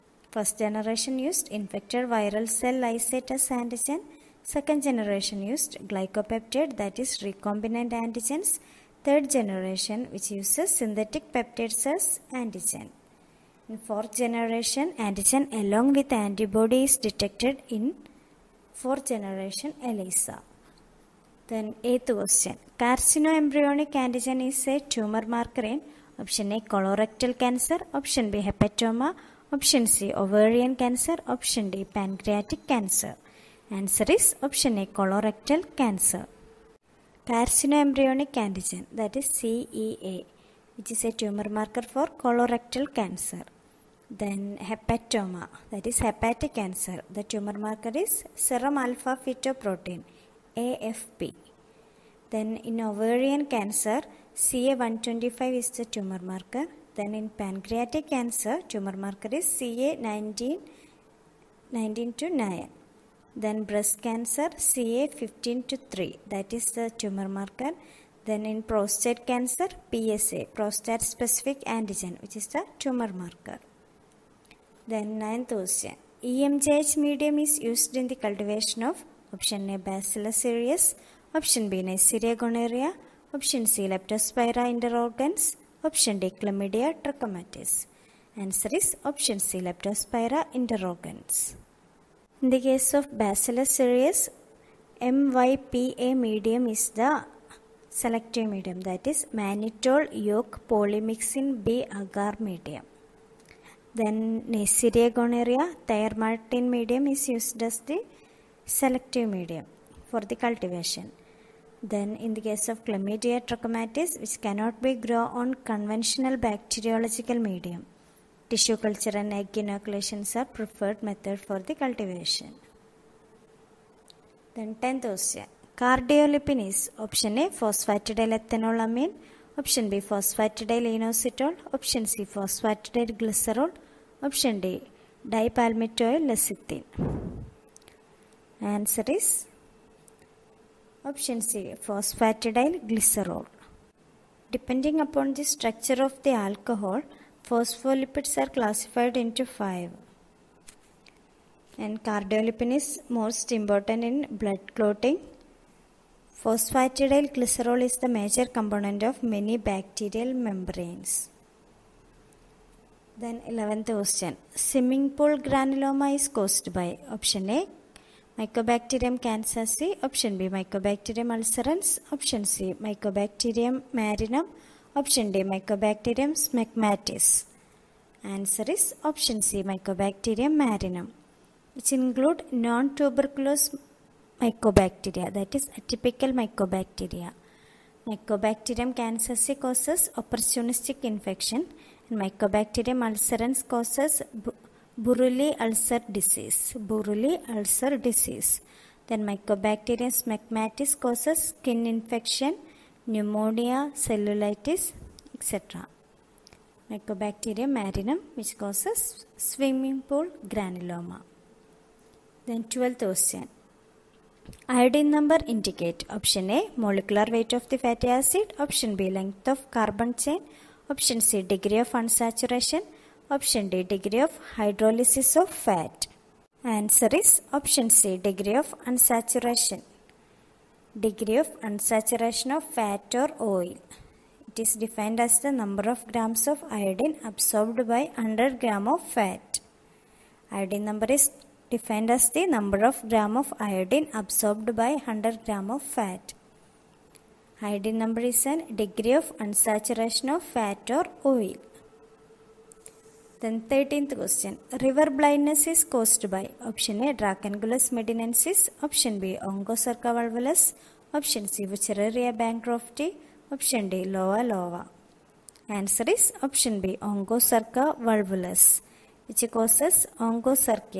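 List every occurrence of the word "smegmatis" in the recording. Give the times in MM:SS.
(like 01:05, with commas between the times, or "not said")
02:56, 03:20.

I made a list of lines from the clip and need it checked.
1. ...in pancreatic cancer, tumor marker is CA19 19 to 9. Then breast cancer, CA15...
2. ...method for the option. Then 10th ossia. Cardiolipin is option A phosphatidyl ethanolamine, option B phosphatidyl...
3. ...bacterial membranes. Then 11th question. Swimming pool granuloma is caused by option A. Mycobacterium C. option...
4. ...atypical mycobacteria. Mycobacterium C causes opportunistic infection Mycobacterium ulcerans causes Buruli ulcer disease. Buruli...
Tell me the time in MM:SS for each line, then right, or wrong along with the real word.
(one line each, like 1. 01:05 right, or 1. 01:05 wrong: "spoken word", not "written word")
1. 00:57 right
2. 02:01 wrong: "cultivation", not "option"
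3. 02:39 right
4. 03:05 right.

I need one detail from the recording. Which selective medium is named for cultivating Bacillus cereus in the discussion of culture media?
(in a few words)
MYPA medium.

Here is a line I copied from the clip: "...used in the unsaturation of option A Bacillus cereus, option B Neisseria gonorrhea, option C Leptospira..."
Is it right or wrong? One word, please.
wrong.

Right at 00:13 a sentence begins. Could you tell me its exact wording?
In fourth generation, antigen along with antibody is detected in for generation ELISA.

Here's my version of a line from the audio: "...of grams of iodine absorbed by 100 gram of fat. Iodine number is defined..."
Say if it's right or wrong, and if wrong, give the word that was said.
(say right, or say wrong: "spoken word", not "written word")
right.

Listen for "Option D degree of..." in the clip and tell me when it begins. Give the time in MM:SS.
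03:43.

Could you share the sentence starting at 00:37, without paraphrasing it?
Carcinoembryonic antigen that is CEA which is a tumor marker for colorectal cancer.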